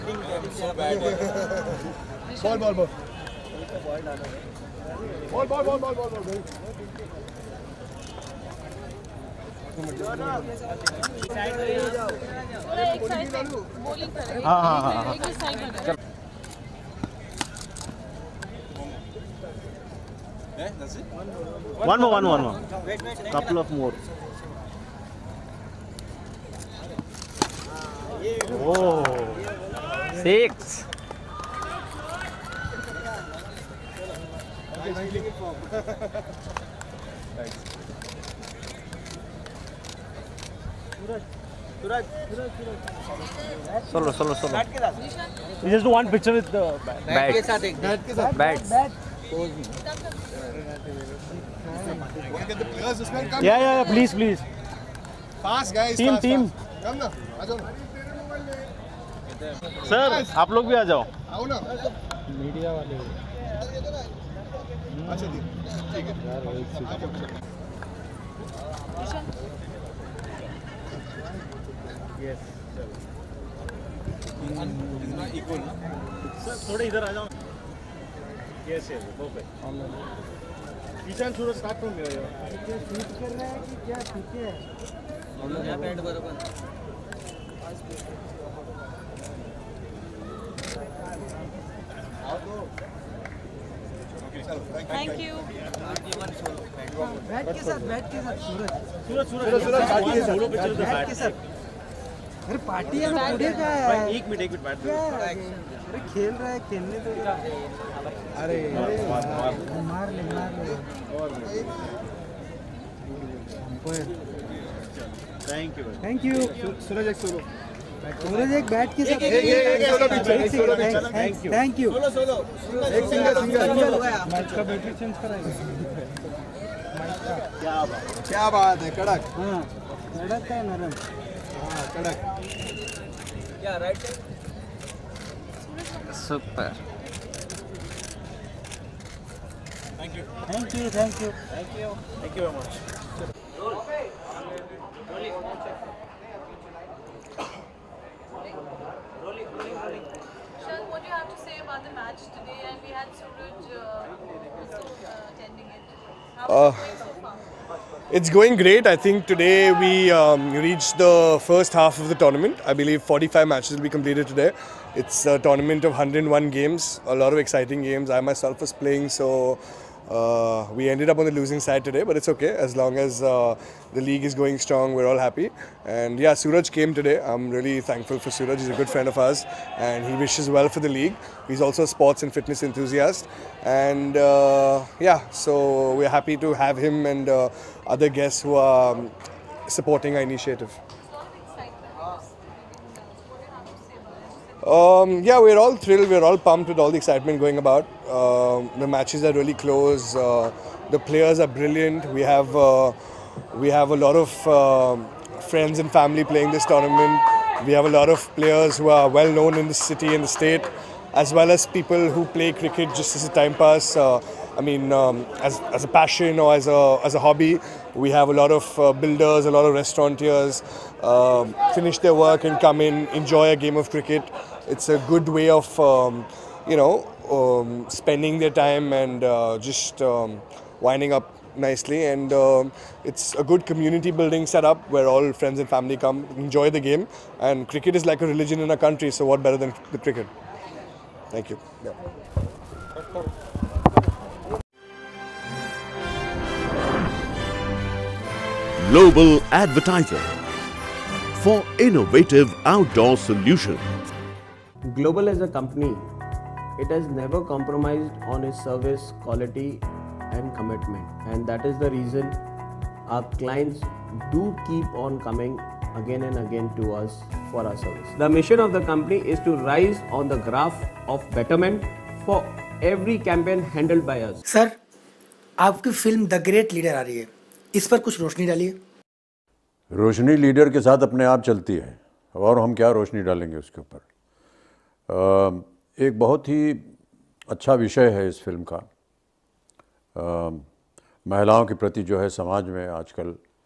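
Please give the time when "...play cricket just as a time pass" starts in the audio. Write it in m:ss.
3:32.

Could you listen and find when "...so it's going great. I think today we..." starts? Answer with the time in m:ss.
2:36.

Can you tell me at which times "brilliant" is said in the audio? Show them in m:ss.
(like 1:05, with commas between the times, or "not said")
3:21.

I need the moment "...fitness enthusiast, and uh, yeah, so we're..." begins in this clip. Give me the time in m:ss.
3:02.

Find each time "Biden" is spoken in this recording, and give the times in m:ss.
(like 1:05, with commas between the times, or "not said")
not said.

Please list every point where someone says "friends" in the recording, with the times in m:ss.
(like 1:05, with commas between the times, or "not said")
2:58, 3:25, 3:55.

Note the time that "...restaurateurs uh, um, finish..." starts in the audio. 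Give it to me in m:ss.
3:39.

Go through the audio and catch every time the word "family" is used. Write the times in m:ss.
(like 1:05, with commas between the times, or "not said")
3:25, 3:55.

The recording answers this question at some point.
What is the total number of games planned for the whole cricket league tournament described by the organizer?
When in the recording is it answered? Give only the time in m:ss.
2:45.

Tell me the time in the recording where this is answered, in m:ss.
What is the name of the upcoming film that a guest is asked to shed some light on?
4:36.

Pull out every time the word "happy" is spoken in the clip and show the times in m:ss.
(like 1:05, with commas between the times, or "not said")
2:55, 3:06.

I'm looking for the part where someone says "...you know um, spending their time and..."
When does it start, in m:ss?
3:46.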